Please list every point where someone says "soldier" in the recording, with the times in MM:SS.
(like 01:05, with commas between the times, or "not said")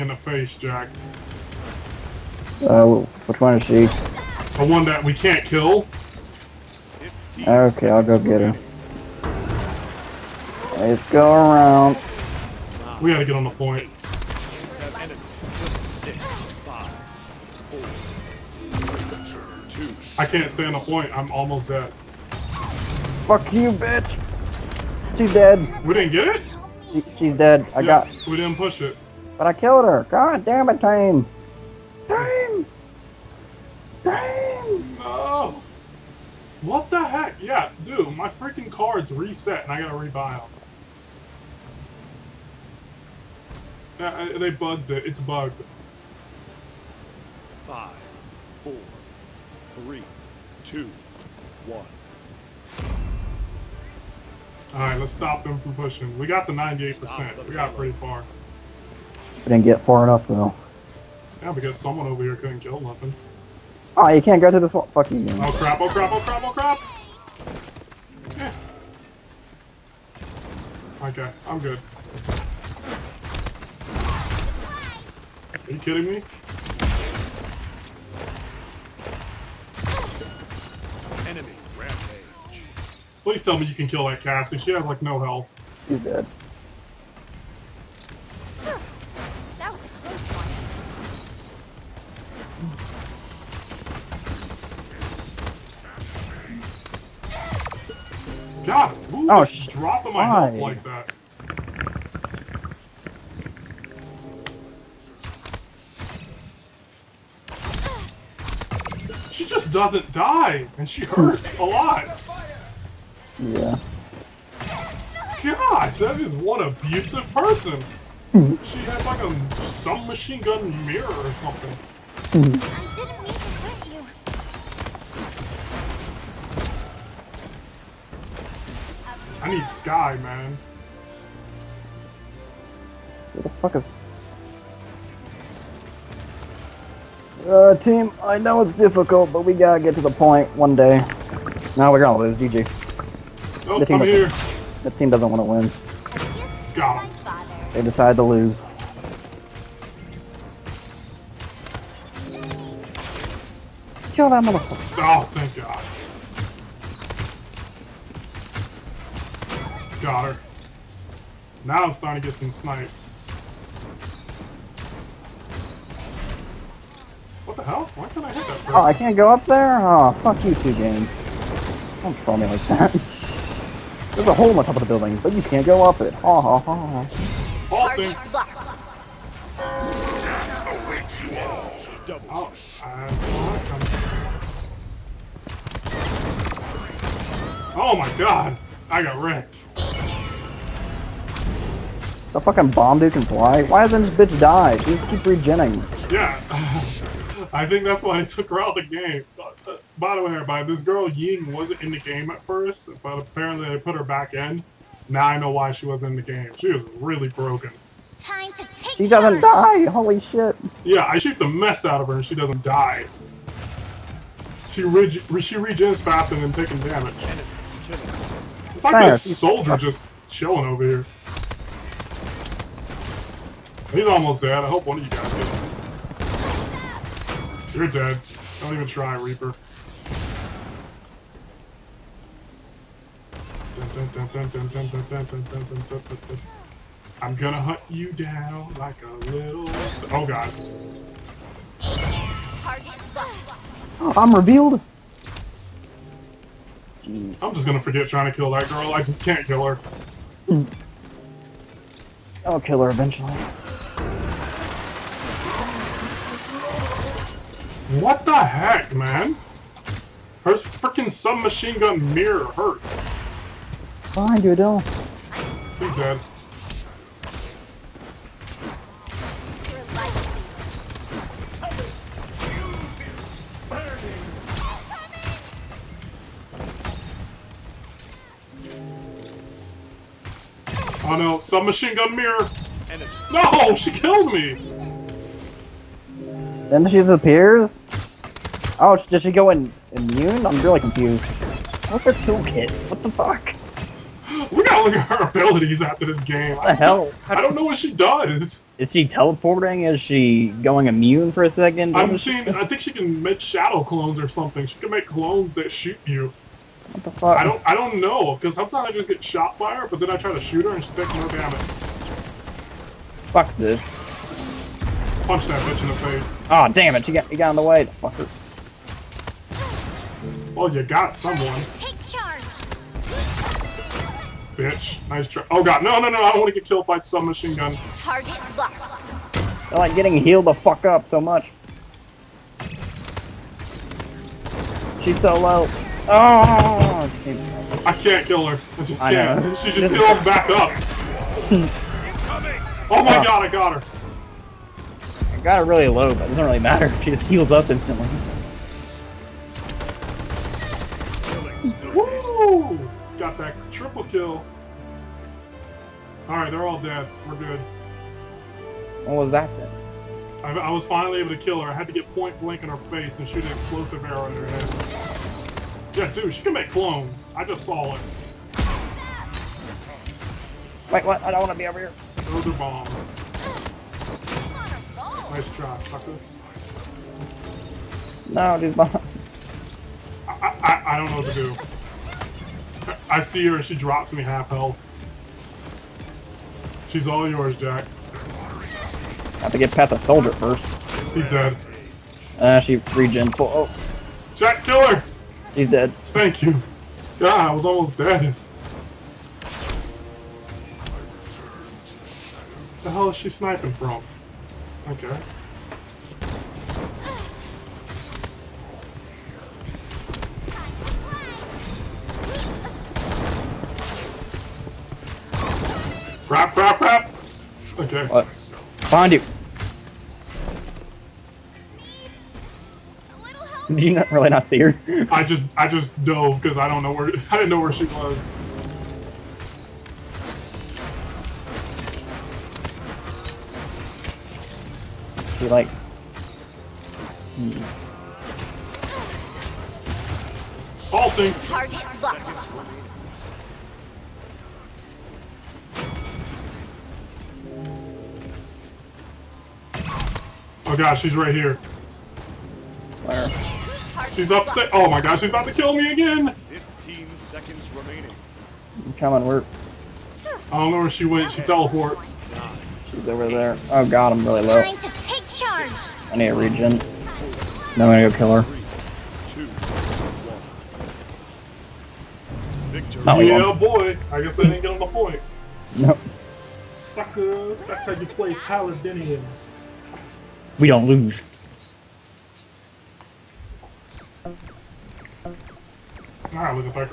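03:39, 06:29.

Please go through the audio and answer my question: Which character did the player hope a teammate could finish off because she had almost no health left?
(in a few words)
Cassie.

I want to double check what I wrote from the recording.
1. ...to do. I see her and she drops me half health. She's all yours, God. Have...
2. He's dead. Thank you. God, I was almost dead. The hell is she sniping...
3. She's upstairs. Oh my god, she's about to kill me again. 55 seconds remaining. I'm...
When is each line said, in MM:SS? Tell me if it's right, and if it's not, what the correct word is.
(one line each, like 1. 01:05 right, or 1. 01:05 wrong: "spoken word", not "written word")
1. 06:21 wrong: "Jack", not "God"
2. 06:35 right
3. 07:34 wrong: "15", not "55".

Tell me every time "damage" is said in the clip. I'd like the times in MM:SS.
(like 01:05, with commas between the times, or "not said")
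03:36, 05:11.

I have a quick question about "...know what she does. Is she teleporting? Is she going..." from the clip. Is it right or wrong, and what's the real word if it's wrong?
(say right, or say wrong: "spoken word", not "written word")
right.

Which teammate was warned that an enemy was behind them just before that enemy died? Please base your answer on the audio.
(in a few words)
Adel.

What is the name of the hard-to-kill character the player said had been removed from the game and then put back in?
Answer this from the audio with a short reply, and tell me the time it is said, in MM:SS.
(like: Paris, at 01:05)
Ying, at 03:21.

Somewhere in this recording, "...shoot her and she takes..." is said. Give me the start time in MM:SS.
05:10.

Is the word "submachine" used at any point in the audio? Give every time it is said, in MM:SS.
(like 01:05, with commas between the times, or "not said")
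04:21, 04:41.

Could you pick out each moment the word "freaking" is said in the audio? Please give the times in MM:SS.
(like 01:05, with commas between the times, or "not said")
00:38, 04:20.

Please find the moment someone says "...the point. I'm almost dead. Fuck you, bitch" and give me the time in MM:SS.
00:20.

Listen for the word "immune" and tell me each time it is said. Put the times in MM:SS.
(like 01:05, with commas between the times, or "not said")
04:49, 05:00.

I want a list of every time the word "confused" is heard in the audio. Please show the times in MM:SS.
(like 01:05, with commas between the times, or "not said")
04:50.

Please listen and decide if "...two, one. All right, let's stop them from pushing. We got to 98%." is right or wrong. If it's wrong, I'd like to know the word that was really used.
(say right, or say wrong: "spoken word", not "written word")
right.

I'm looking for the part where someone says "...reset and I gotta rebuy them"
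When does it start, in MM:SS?
00:39.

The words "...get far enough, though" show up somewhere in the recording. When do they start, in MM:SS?
00:59.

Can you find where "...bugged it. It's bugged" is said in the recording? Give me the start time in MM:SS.
00:44.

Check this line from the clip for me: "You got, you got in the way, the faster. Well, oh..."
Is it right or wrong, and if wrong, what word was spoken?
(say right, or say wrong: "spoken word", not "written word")
wrong: "fucker", not "faster".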